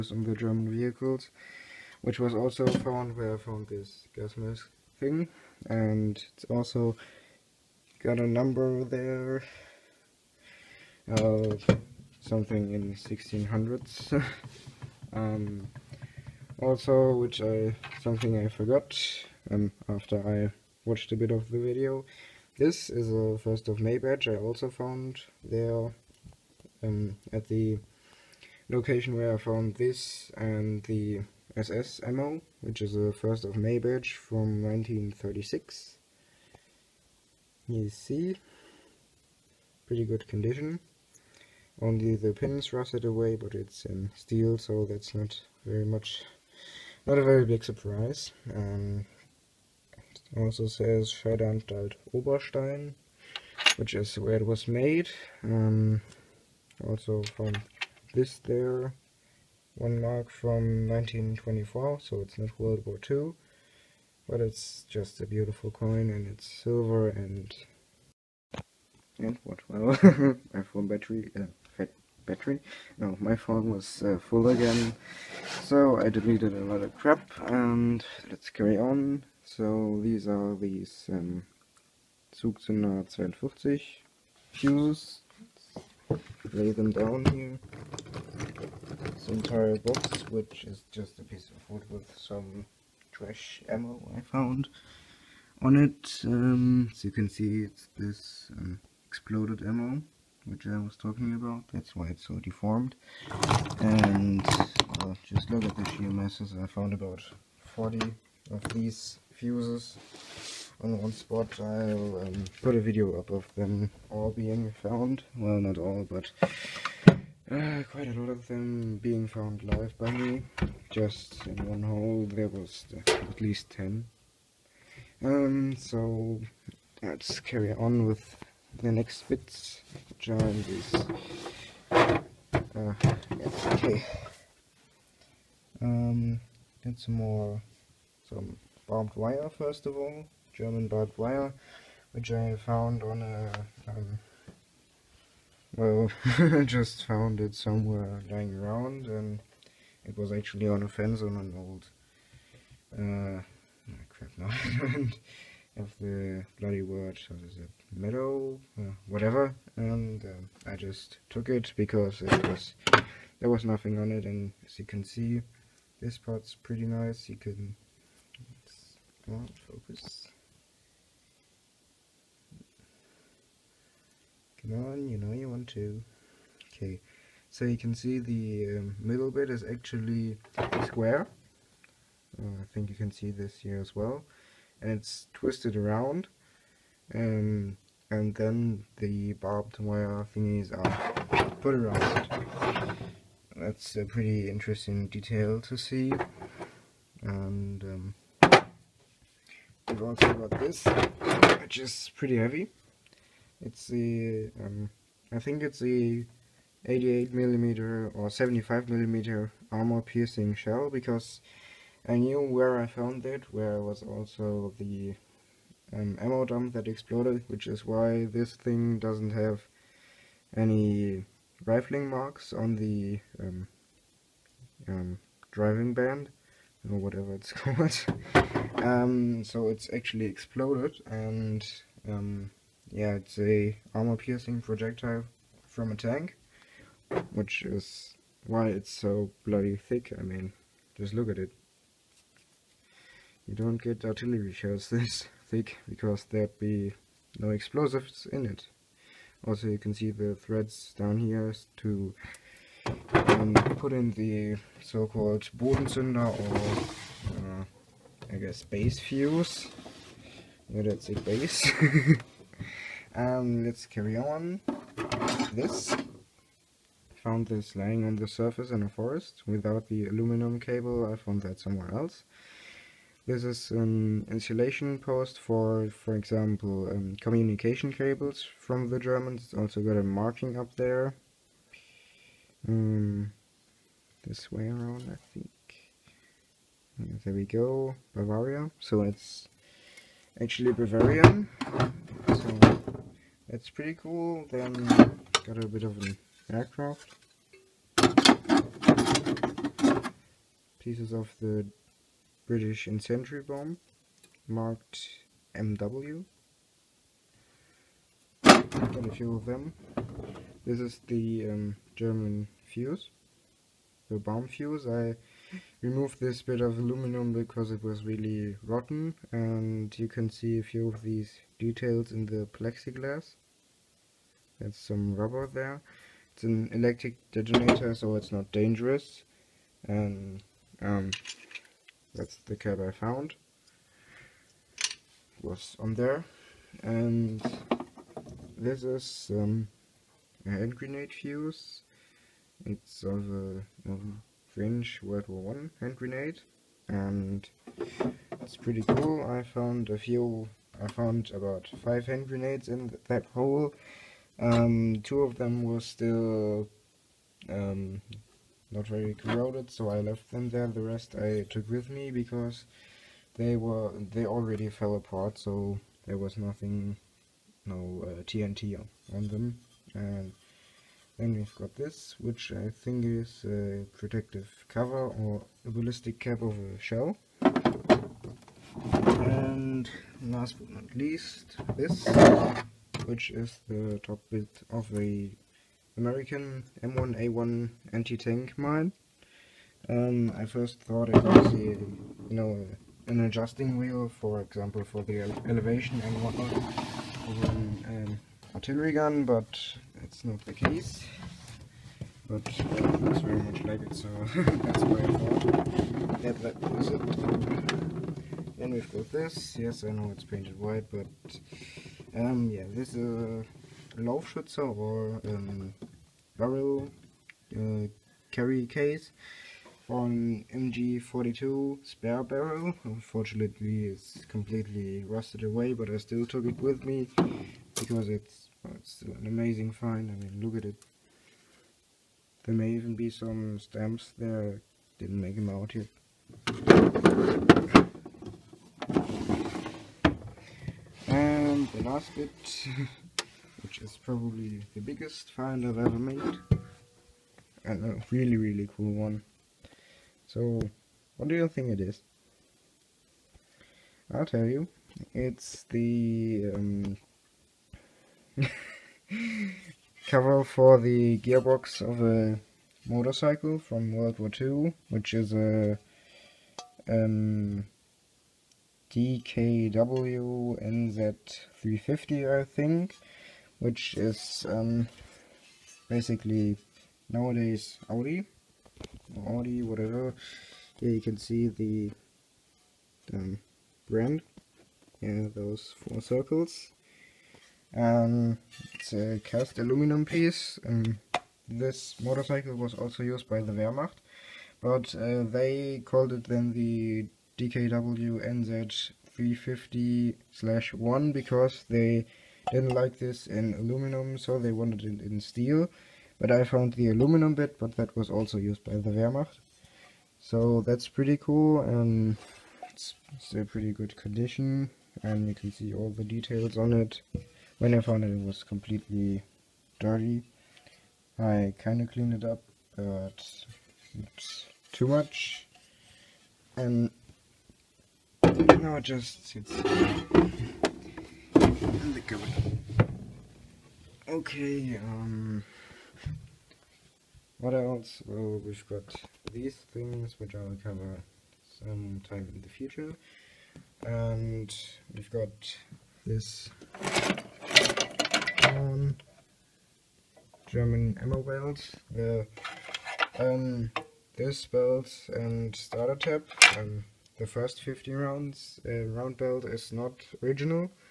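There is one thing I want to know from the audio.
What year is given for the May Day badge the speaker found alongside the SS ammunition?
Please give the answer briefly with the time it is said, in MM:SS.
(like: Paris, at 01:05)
1936, at 00:34.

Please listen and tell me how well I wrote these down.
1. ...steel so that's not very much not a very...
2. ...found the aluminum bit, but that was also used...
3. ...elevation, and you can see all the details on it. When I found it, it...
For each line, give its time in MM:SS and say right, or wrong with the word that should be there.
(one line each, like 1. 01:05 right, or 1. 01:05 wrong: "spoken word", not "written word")
1. 00:44 right
2. 08:26 right
3. 08:33 wrong: "condition", not "elevation".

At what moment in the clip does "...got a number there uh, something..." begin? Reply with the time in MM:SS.
00:08.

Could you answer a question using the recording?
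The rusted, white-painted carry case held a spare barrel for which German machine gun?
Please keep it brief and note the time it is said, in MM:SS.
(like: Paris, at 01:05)
MG42, at 07:00.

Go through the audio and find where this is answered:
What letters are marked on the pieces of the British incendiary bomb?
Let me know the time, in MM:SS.
05:05.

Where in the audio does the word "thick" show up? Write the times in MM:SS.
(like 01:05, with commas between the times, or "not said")
03:59, 04:05.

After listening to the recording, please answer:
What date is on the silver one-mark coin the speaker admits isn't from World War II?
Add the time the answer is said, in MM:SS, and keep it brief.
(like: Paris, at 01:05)
1924, at 01:00.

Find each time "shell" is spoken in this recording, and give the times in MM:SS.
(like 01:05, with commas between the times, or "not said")
03:30, 04:04, 06:16.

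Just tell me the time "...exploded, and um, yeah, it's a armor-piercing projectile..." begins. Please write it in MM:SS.
03:50.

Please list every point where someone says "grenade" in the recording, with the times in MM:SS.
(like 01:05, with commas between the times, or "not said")
05:40, 05:45, 05:52.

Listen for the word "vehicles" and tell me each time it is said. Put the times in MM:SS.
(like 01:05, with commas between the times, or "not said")
00:00.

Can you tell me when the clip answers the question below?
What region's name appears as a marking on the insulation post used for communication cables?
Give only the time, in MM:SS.
04:48.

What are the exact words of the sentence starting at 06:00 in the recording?
The rest I took with me because they were they already fell apart, so there was nothing, no uh, TNT on them.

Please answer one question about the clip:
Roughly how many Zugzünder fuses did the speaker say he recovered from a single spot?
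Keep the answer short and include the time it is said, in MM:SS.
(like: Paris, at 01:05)
40, at 01:47.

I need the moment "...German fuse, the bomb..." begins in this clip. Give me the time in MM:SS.
05:11.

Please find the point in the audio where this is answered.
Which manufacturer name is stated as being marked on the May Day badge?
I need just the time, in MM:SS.
00:51.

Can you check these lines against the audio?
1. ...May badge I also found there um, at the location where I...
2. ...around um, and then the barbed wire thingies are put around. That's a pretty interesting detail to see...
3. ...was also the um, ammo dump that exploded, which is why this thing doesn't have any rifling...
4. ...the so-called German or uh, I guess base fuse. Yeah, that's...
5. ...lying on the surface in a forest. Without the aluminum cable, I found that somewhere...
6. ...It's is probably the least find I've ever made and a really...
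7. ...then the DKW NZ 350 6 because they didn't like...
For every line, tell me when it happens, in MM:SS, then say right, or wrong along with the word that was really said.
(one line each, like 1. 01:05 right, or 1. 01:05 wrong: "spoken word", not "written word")
1. 00:23 right
2. 03:05 right
3. 03:33 right
4. 04:14 wrong: "Bodenzünder", not "German"
5. 04:27 right
6. 07:23 wrong: "biggest", not "least"
7. 08:16 wrong: "1", not "6".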